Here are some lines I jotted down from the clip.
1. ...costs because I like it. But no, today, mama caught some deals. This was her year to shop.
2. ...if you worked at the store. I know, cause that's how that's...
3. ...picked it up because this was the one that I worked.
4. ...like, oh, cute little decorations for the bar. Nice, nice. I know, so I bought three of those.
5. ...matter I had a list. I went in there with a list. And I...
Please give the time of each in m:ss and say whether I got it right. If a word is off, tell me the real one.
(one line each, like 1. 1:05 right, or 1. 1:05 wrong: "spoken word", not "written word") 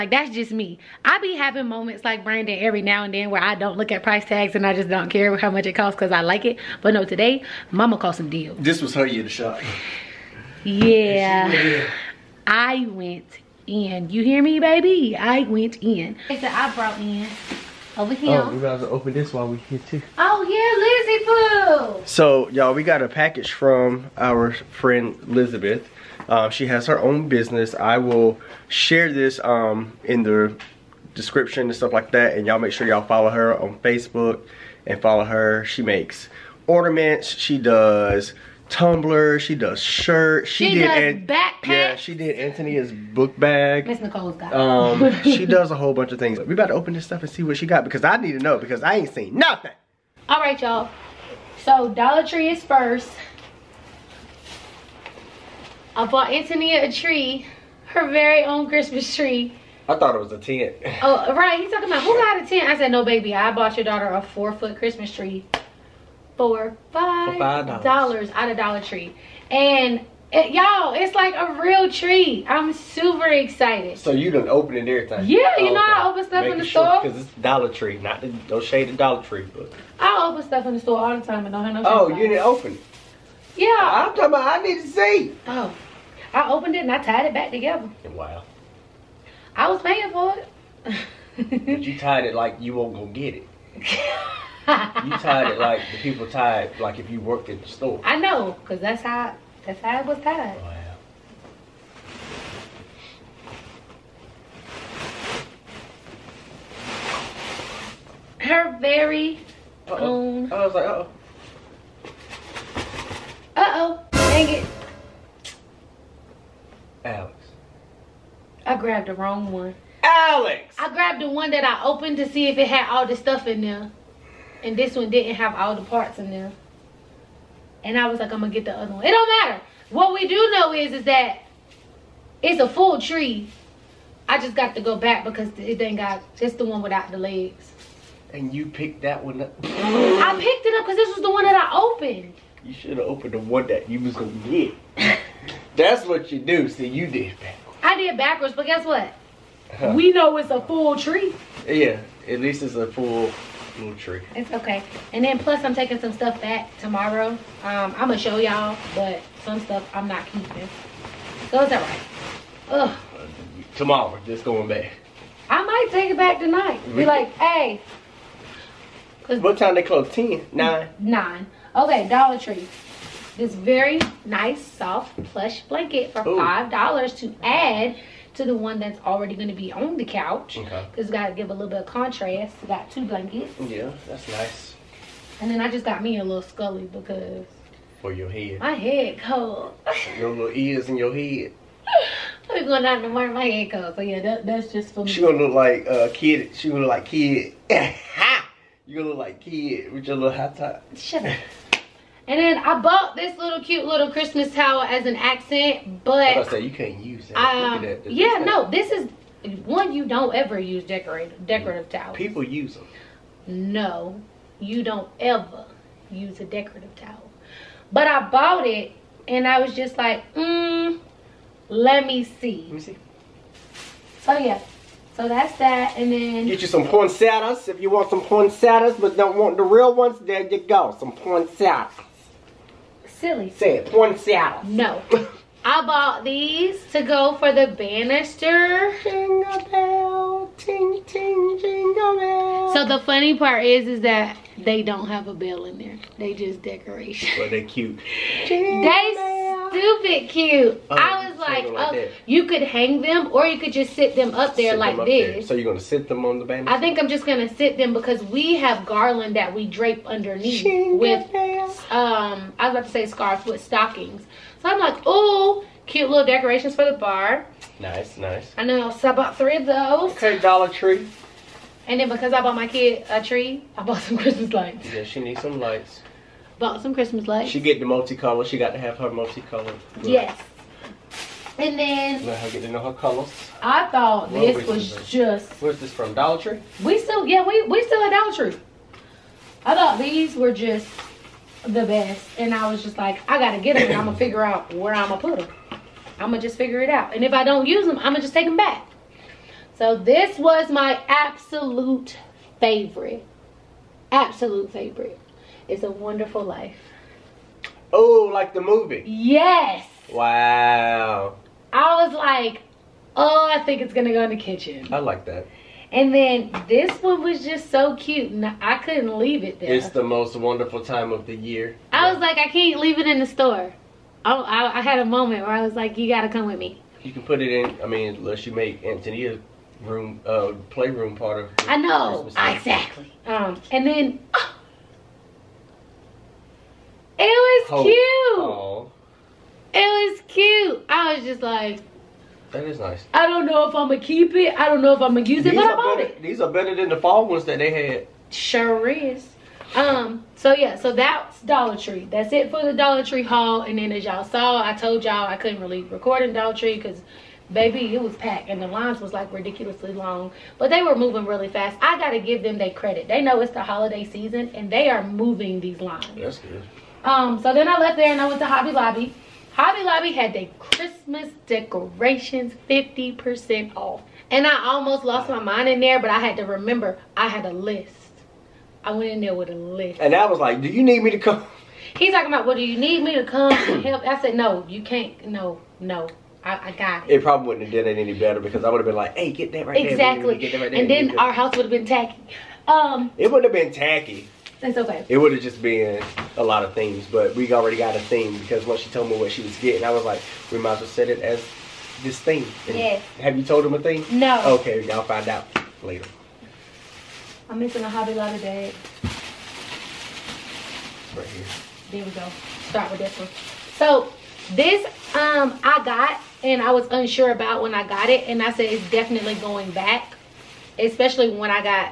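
1. 0:05 right
2. 1:36 right
3. 2:20 wrong: "opened", not "worked"
4. 4:24 right
5. 6:16 wrong: "remember", not "matter".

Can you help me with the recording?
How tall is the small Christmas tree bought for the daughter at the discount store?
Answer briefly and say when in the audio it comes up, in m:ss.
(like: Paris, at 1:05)
4 feet, at 1:04.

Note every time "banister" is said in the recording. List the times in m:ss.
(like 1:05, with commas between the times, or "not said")
3:57, 4:16.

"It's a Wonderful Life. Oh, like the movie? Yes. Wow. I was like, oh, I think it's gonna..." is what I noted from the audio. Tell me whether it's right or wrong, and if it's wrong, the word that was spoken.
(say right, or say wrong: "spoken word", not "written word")
right.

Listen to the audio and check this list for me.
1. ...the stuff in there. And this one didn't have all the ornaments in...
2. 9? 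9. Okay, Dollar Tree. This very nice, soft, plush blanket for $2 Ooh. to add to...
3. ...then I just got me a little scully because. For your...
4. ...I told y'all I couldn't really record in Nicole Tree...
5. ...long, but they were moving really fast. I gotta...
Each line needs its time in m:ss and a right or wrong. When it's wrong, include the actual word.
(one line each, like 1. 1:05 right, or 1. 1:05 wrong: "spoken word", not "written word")
1. 2:03 wrong: "parts", not "ornaments"
2. 2:50 wrong: "5", not "2"
3. 3:05 right
4. 5:54 wrong: "Dollar", not "Nicole"
5. 5:59 right.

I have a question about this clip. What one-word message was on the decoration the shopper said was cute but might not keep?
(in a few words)
Hope.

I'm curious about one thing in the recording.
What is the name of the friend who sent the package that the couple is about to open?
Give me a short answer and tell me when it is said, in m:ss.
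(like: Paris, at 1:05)
Elizabeth, at 0:25.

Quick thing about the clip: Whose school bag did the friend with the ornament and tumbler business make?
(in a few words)
Anthony.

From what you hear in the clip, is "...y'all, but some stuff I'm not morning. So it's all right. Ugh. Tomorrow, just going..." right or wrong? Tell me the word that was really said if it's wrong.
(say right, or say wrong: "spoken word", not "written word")
wrong: "keeping", not "morning".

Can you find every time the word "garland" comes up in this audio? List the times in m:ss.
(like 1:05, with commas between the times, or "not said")
4:18.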